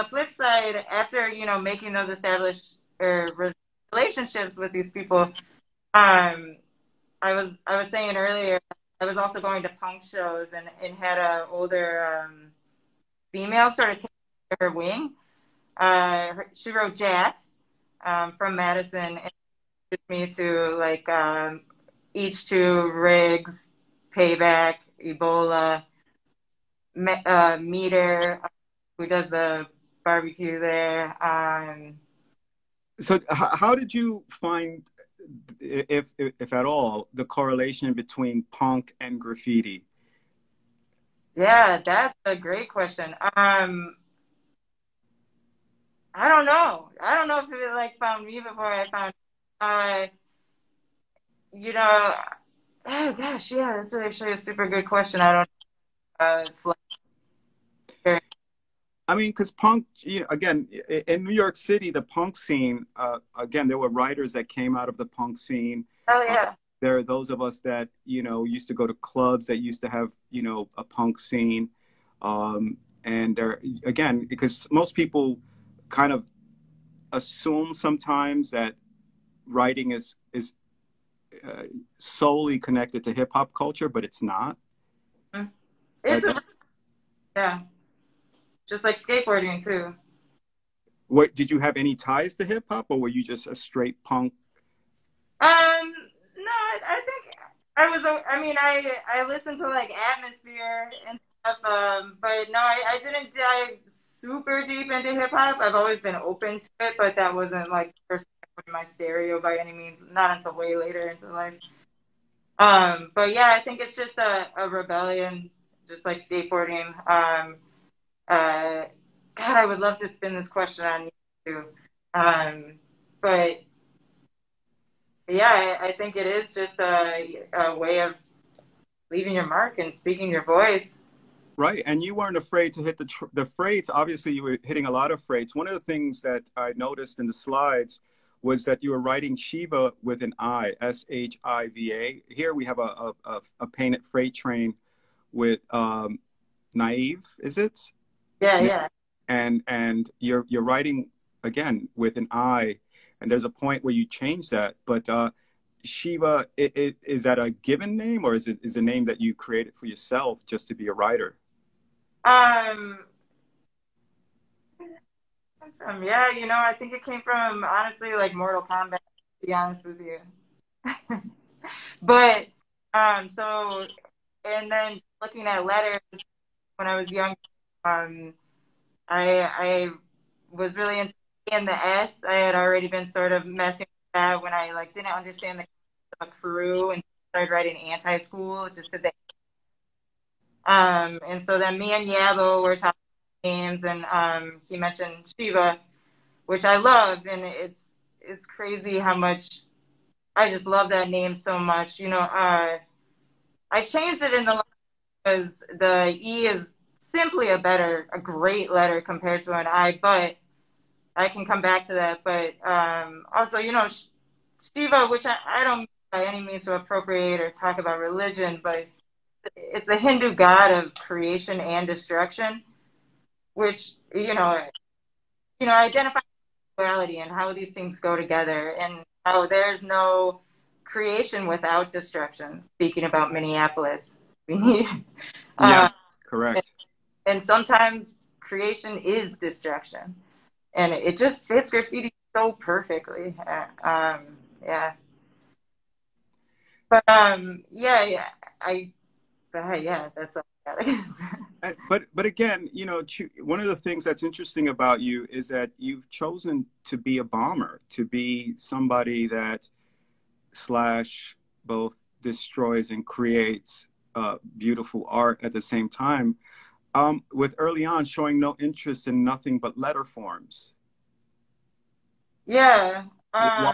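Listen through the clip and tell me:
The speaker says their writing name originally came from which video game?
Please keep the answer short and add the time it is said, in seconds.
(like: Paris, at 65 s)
Mortal Kombat, at 168 s.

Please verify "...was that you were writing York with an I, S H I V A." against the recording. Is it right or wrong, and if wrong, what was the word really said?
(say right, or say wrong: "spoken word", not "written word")
wrong: "Shiva", not "York".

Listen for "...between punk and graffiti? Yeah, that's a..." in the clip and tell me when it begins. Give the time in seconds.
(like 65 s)
37 s.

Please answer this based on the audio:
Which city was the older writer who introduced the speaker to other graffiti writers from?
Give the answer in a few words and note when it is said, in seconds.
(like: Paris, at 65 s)
Madison, at 18 s.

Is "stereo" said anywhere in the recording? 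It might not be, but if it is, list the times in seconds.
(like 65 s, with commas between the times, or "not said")
108 s.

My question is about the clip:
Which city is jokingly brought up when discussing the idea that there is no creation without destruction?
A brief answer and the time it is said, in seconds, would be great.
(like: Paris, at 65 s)
Minneapolis, at 233 s.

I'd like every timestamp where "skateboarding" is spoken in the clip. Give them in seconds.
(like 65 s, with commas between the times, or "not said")
89 s, 116 s.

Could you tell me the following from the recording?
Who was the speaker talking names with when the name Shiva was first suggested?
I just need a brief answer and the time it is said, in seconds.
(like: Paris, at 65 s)
Yabo, at 192 s.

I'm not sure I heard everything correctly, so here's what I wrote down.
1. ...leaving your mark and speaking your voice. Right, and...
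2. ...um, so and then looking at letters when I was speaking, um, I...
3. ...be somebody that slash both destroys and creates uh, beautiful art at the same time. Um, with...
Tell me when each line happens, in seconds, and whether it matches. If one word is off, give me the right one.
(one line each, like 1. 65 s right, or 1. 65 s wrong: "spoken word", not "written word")
1. 129 s right
2. 172 s wrong: "young", not "speaking"
3. 258 s right.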